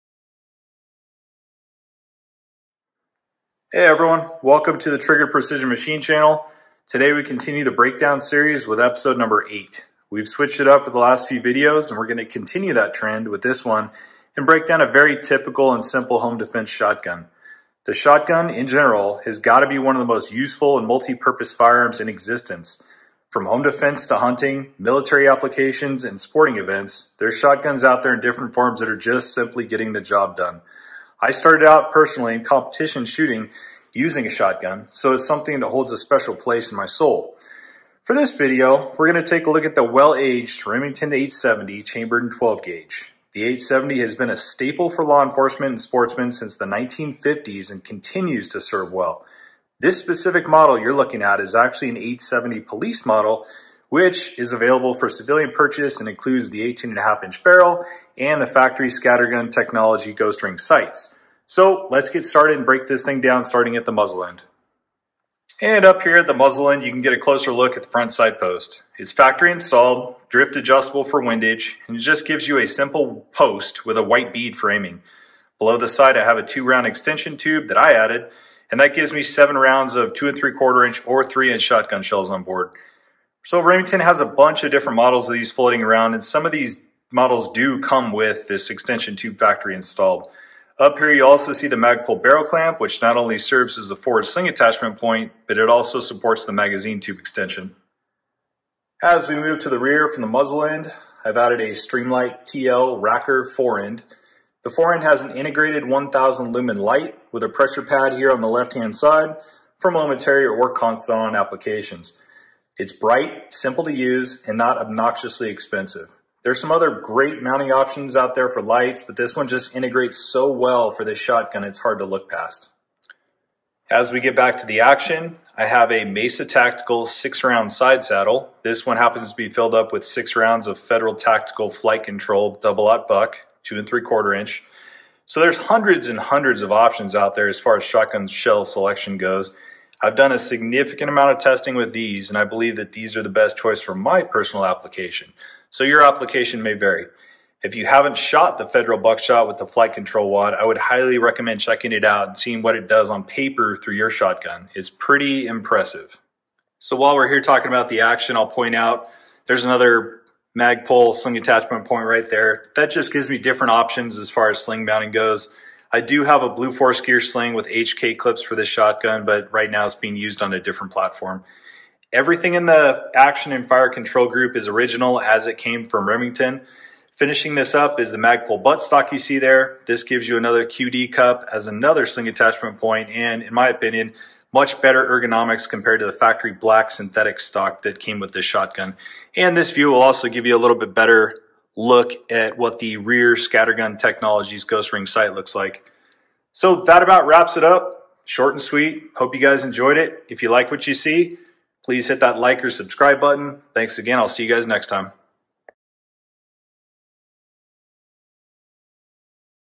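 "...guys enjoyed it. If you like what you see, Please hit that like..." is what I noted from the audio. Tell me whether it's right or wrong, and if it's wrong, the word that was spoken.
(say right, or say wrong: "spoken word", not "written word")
right.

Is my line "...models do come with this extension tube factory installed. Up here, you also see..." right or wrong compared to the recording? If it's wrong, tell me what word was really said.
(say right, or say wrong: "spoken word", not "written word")
right.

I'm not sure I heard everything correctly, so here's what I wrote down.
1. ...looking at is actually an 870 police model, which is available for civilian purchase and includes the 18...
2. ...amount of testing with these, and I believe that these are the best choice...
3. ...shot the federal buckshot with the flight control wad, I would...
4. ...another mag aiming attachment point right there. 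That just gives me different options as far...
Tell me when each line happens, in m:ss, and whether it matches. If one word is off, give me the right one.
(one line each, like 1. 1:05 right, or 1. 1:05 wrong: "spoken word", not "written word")
1. 0:50 right
2. 2:21 right
3. 2:28 right
4. 2:39 wrong: "sling", not "aiming".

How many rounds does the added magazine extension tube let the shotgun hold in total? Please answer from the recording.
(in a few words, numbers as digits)
7.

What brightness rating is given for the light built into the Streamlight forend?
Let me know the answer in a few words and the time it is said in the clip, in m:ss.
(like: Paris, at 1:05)
1000 lumens, at 1:45.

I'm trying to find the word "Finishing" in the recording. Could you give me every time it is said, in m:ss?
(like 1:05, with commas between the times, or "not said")
2:57.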